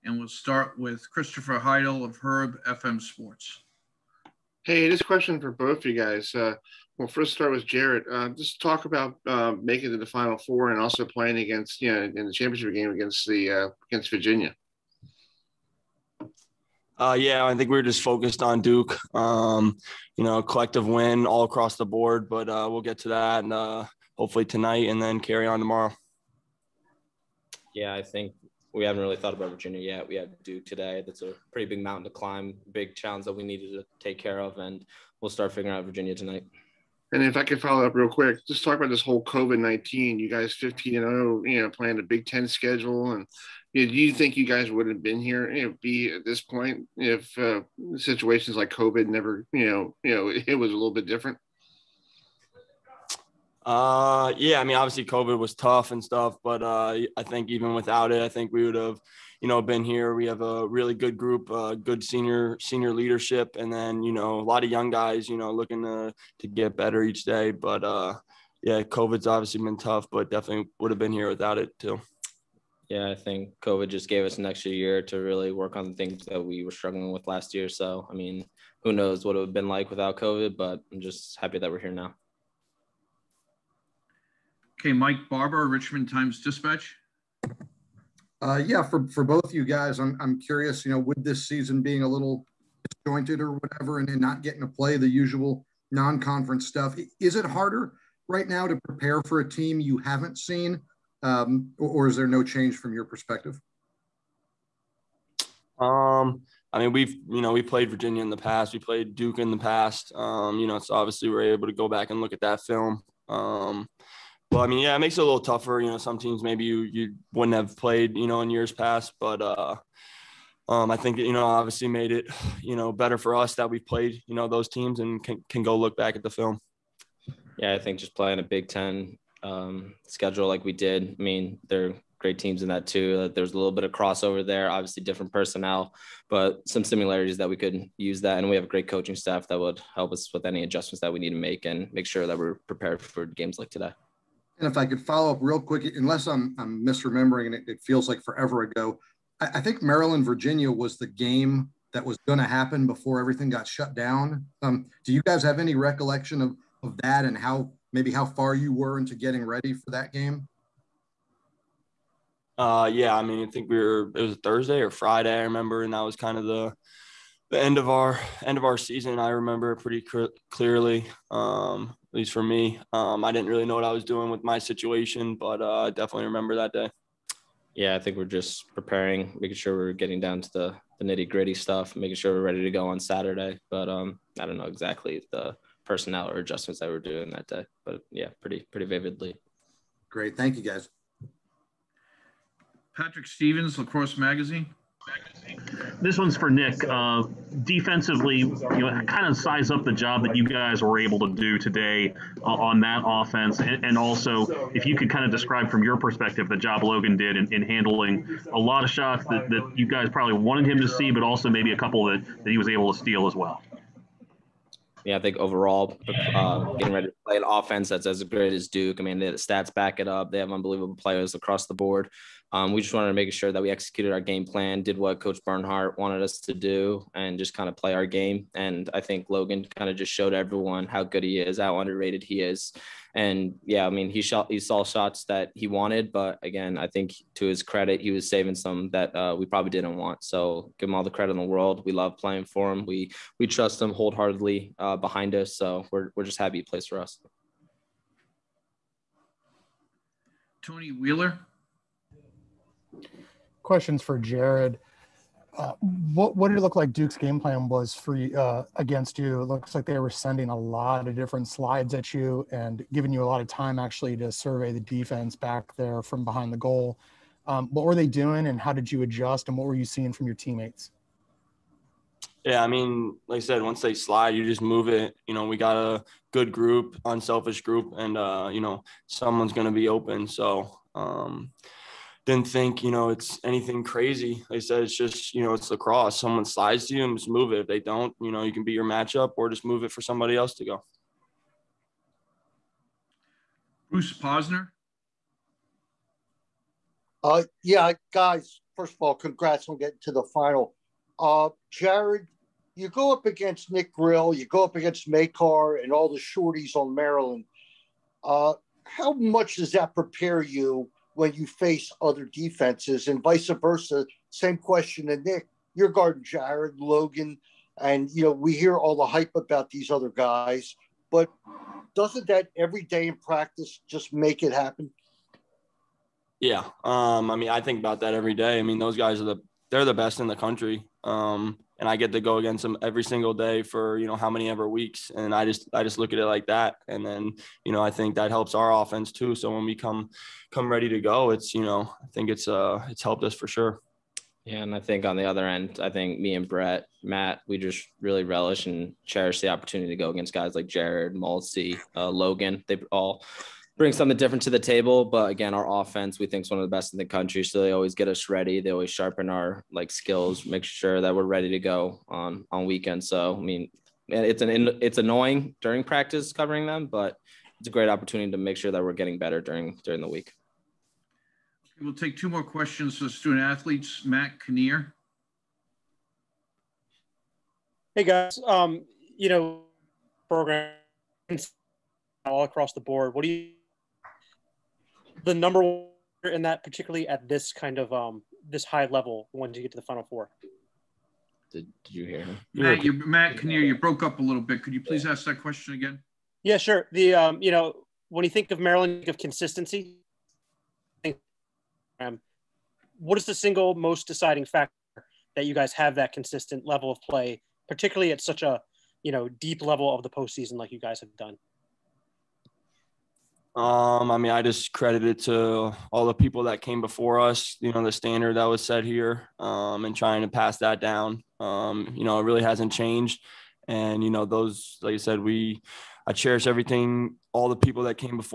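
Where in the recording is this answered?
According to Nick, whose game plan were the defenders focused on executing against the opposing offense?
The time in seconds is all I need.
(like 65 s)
225 s.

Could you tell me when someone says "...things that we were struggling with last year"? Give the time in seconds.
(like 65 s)
75 s.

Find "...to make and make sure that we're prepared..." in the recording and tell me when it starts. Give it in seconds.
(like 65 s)
141 s.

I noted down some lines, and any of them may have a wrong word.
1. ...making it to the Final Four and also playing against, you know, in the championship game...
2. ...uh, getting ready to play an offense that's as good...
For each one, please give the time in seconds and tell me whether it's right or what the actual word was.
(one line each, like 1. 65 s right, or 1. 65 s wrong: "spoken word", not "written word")
1. 9 s right
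2. 216 s right.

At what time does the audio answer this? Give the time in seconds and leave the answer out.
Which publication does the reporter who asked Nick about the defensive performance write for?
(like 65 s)
193 s.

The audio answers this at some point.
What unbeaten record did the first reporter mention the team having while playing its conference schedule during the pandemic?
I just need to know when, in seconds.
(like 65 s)
40 s.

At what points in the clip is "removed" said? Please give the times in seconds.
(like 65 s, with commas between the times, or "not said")
not said.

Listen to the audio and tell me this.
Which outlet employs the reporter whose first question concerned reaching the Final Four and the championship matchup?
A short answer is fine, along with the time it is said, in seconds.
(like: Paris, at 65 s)
Herb FM Sports, at 2 s.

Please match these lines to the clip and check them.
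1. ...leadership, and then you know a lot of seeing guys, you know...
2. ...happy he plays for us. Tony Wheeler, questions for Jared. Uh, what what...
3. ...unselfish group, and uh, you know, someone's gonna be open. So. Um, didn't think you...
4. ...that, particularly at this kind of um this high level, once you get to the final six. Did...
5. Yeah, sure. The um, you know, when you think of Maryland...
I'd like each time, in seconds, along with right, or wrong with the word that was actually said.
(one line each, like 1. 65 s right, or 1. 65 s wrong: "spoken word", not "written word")
1. 62 s wrong: "young", not "seeing"
2. 246 s right
3. 277 s right
4. 386 s wrong: "four", not "six"
5. 396 s right.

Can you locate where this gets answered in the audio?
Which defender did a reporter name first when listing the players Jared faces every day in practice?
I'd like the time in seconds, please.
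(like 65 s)
303 s.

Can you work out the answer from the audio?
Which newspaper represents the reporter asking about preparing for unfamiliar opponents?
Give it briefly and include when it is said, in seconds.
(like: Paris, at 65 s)
Richmond Times Dispatch, at 85 s.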